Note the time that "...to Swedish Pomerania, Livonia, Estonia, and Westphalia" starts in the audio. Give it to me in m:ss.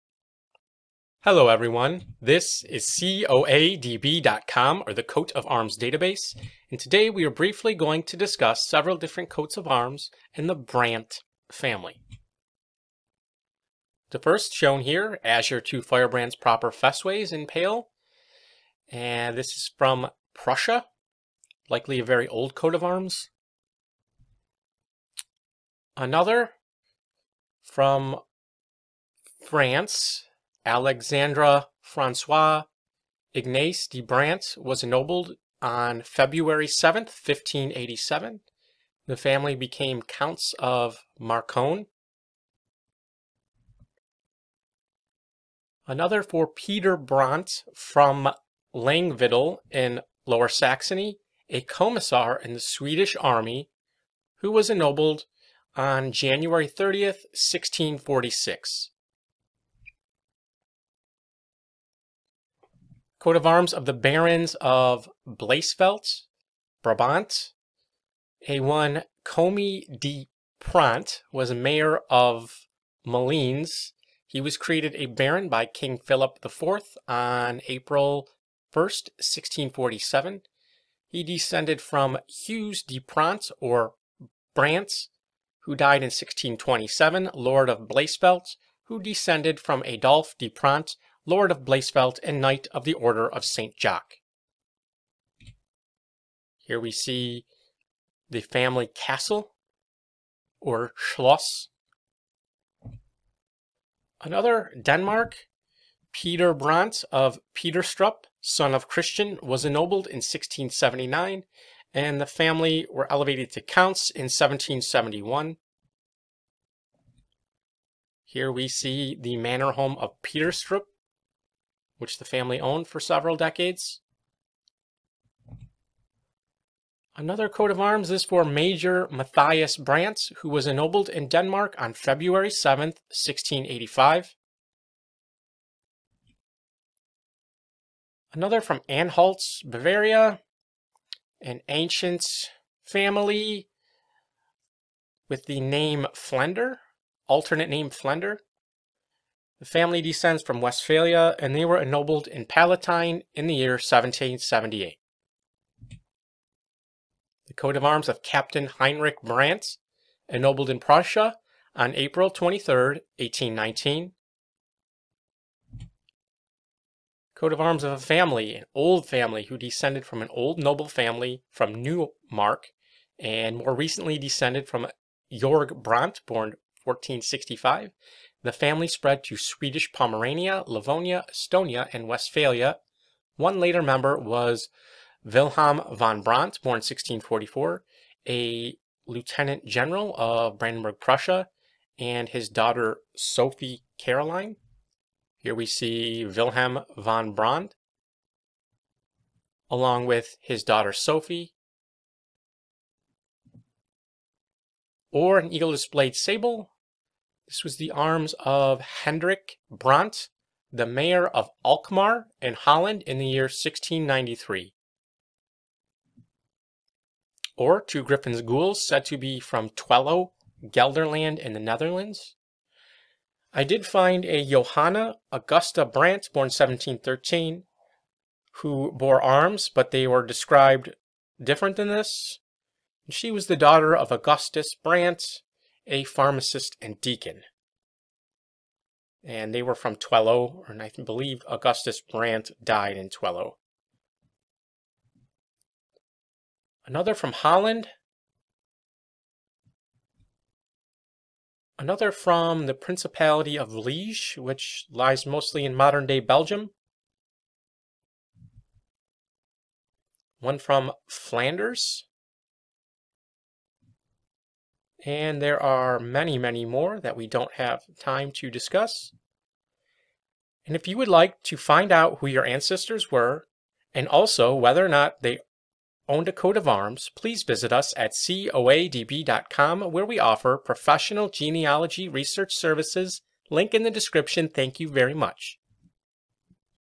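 2:59.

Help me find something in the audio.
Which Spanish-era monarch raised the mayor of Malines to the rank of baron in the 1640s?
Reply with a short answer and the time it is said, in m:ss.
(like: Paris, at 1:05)
King Philip IV, at 1:15.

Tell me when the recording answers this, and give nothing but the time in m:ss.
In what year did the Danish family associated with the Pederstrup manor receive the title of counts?
1:54.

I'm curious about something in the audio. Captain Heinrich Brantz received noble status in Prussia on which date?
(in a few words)
April 23, 1819.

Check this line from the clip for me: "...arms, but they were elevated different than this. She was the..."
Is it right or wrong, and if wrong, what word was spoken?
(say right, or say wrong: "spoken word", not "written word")
wrong: "described", not "elevated".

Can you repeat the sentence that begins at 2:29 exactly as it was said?
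The family descends from Westphalia, and they were ennobled in Palatine in the year 1778.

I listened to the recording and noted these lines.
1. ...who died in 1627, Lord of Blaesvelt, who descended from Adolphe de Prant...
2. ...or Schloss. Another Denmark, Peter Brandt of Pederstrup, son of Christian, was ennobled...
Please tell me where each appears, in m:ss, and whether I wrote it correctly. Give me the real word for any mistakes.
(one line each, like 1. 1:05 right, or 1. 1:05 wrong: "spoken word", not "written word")
1. 1:25 right
2. 1:40 right.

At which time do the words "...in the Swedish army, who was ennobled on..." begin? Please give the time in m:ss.
0:52.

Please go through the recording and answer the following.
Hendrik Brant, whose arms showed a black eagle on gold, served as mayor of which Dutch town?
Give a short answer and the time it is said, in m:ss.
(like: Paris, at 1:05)
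Alkmaar, at 3:31.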